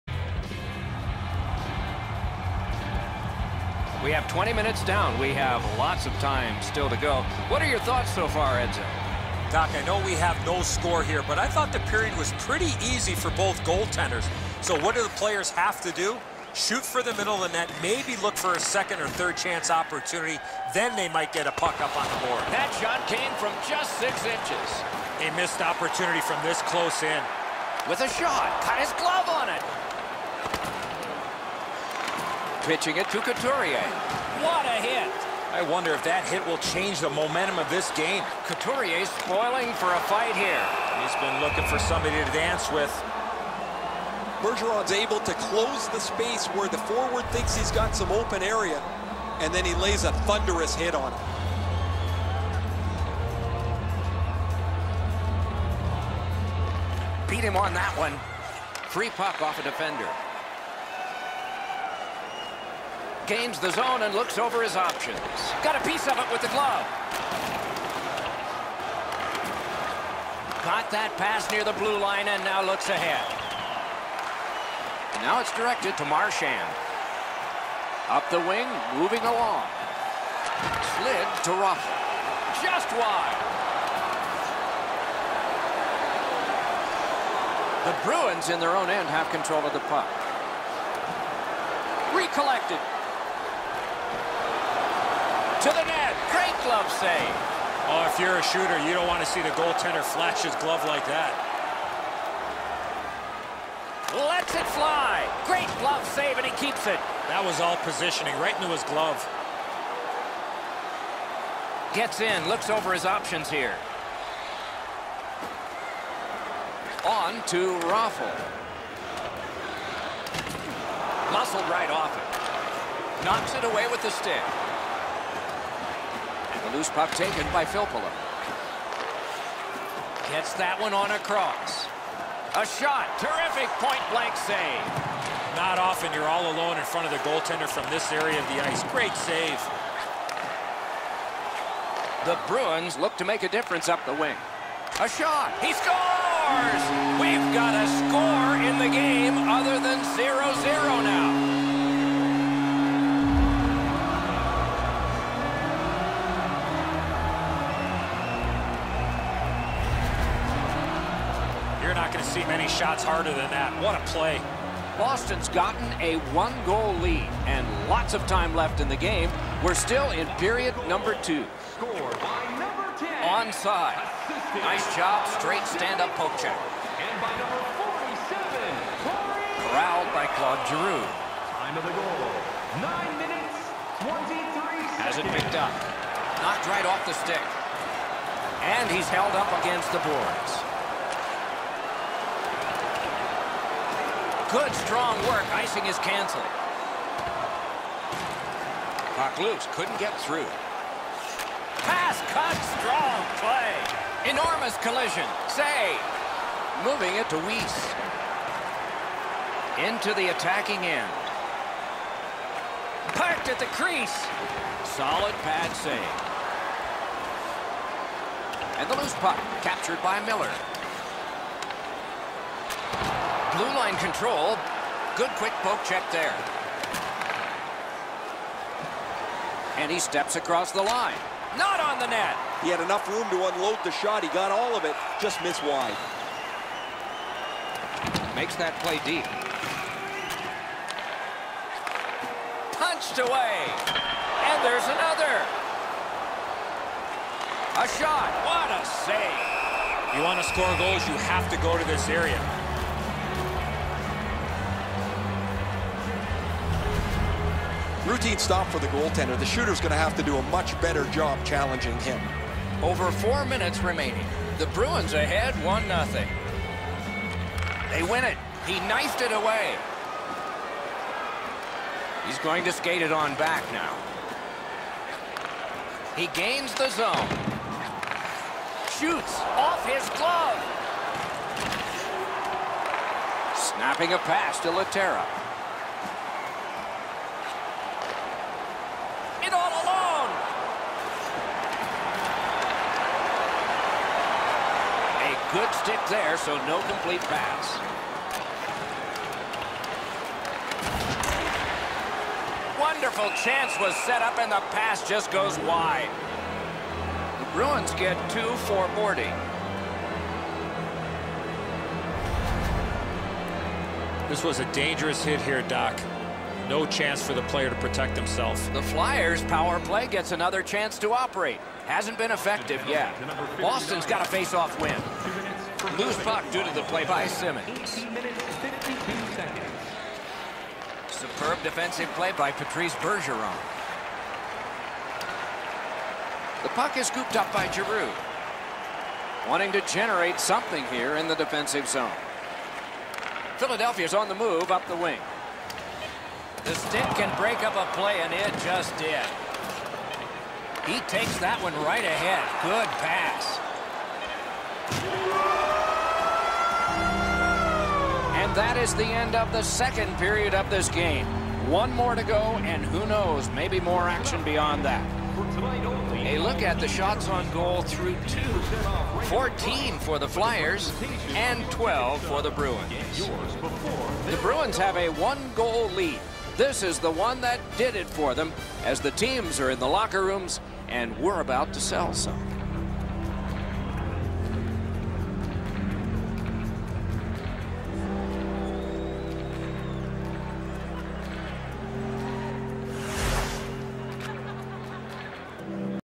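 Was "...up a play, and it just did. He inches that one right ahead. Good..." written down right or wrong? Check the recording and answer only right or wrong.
wrong.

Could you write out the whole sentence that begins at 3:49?
And he steps across the line.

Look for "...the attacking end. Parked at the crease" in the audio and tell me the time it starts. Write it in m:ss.
3:30.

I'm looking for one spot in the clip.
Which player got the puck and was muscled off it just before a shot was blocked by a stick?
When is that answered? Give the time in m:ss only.
1:57.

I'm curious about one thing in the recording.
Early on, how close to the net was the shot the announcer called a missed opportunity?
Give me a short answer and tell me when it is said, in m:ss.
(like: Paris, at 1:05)
6 inches, at 0:23.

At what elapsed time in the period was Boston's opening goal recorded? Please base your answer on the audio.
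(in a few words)
9:23.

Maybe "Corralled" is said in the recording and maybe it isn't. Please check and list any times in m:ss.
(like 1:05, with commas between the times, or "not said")
2:59.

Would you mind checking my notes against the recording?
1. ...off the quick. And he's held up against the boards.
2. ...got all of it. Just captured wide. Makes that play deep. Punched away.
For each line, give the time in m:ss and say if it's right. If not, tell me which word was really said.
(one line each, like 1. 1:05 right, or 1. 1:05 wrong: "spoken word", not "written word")
1. 3:06 wrong: "stick", not "quick"
2. 3:54 wrong: "missed", not "captured".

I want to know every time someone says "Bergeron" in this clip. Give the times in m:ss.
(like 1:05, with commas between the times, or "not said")
0:44, 5:32.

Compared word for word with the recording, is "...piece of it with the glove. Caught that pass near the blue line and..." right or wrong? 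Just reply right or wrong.
right.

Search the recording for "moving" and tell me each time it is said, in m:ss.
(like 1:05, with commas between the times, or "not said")
1:18, 3:26.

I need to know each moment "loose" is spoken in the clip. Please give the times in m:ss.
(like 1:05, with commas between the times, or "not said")
2:06, 3:19, 3:39, 5:25.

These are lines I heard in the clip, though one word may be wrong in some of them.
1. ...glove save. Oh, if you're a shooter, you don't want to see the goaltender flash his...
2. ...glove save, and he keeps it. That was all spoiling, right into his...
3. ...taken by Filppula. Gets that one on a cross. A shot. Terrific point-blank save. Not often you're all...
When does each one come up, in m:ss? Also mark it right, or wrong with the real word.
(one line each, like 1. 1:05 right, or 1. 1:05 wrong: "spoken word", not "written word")
1. 1:36 right
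2. 1:45 wrong: "positioning", not "spoiling"
3. 2:07 right.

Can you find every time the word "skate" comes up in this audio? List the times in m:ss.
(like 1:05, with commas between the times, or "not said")
4:32.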